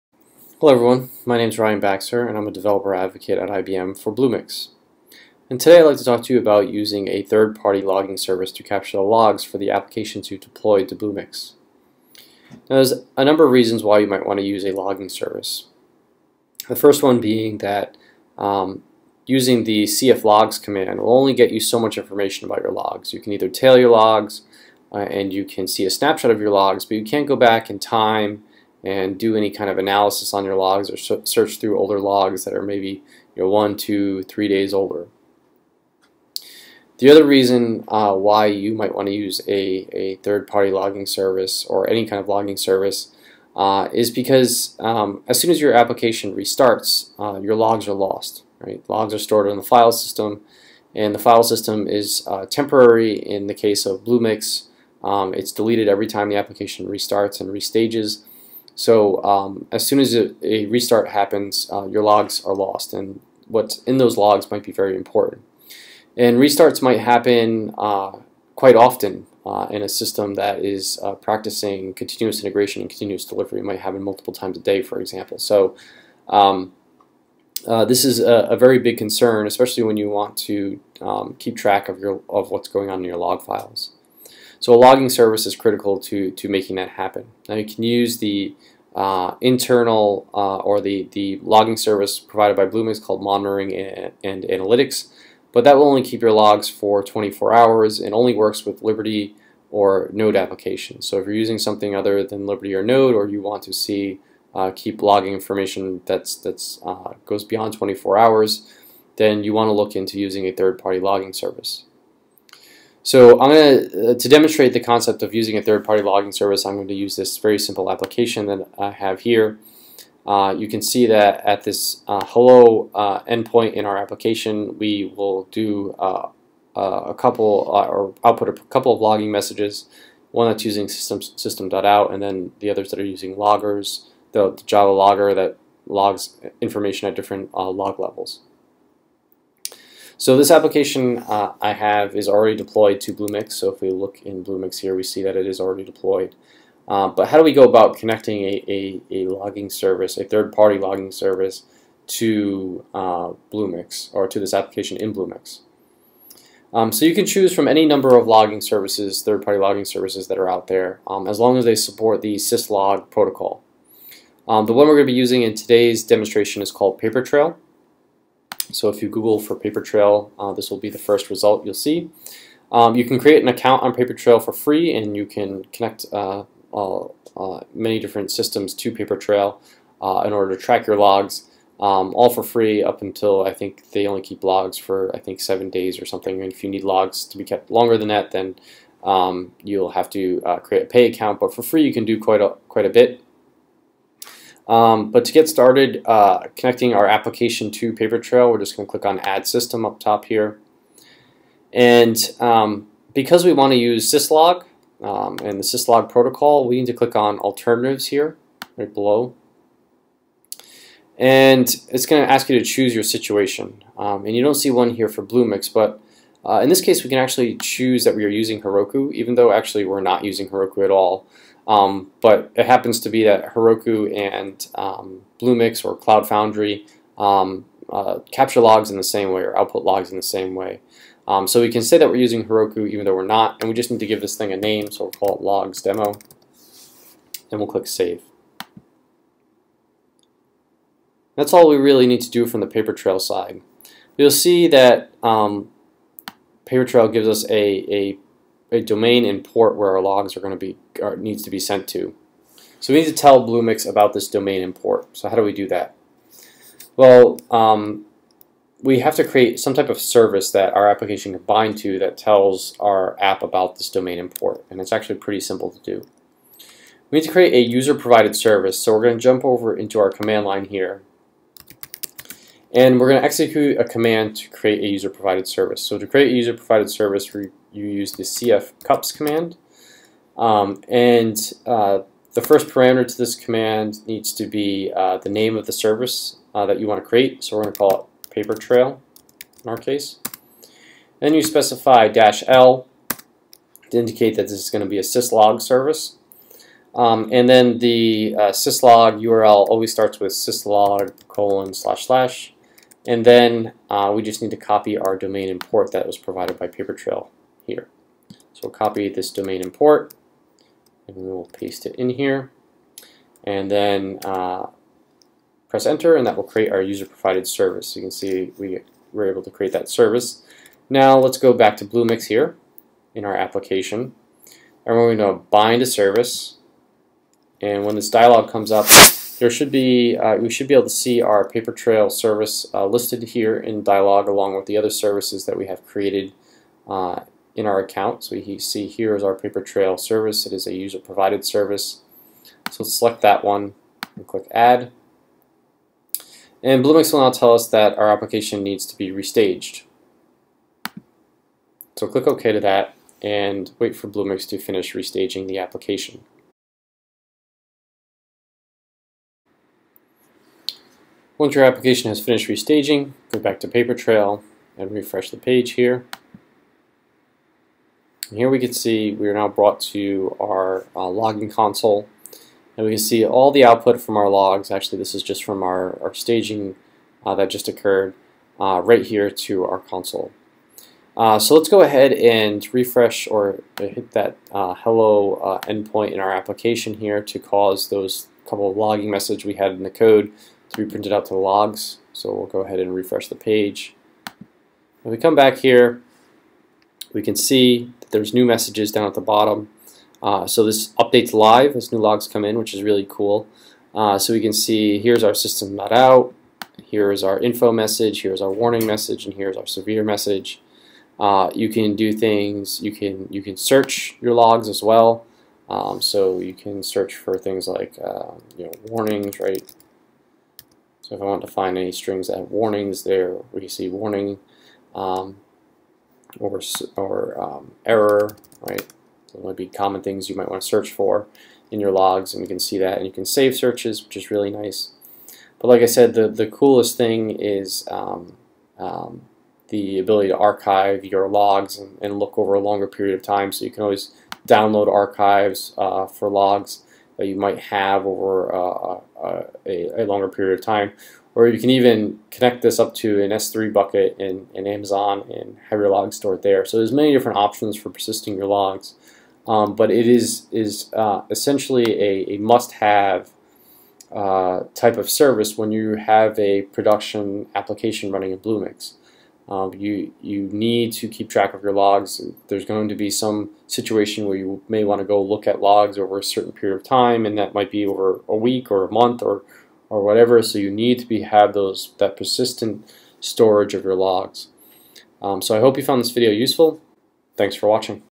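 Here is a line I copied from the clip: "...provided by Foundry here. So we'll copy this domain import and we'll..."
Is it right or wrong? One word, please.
wrong.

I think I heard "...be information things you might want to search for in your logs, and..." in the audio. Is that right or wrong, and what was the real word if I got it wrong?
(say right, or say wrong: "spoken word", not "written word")
wrong: "common", not "information".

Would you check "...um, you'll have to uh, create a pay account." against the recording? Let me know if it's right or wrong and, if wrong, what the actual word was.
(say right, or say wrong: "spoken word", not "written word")
right.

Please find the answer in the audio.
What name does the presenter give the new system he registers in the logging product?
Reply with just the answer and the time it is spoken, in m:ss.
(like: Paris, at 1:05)
logs demo, at 3:55.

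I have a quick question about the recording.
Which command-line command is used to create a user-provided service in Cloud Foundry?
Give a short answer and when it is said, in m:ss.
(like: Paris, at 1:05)
cf cups, at 4:38.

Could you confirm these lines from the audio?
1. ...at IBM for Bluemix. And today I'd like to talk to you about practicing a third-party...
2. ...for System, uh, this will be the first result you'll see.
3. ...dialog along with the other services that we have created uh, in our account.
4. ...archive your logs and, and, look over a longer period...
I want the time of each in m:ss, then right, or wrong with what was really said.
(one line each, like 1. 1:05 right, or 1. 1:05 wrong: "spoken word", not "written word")
1. 0:03 wrong: "using", not "practicing"
2. 2:49 wrong: "PaperTrail", not "System"
3. 5:33 right
4. 7:20 right.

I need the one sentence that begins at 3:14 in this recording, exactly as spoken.
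Um, but to get started uh, connecting our application to Papertrail, we're just going to click on Add System up top here.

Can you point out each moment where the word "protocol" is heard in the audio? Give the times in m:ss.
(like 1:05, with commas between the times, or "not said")
2:43, 3:26.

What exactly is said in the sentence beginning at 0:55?
Um, it's deleted every time the application restarts and restages.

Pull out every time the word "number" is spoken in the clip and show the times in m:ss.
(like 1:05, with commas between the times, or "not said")
0:13, 2:37.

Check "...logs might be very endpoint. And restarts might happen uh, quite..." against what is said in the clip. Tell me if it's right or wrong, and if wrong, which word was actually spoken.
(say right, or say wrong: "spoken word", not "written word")
wrong: "important", not "endpoint".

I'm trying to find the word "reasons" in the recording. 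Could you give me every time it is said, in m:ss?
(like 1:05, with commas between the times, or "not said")
0:13, 0:37.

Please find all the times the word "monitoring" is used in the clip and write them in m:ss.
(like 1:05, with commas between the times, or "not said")
1:33.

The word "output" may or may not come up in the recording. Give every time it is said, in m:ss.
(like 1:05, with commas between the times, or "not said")
2:08, 3:49, 6:13.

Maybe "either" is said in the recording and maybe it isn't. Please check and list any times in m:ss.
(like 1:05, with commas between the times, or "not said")
0:23.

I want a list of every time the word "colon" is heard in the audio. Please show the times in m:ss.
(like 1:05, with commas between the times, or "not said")
5:01.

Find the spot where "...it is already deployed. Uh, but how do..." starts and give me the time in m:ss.
2:25.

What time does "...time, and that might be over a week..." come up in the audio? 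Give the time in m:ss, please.
7:56.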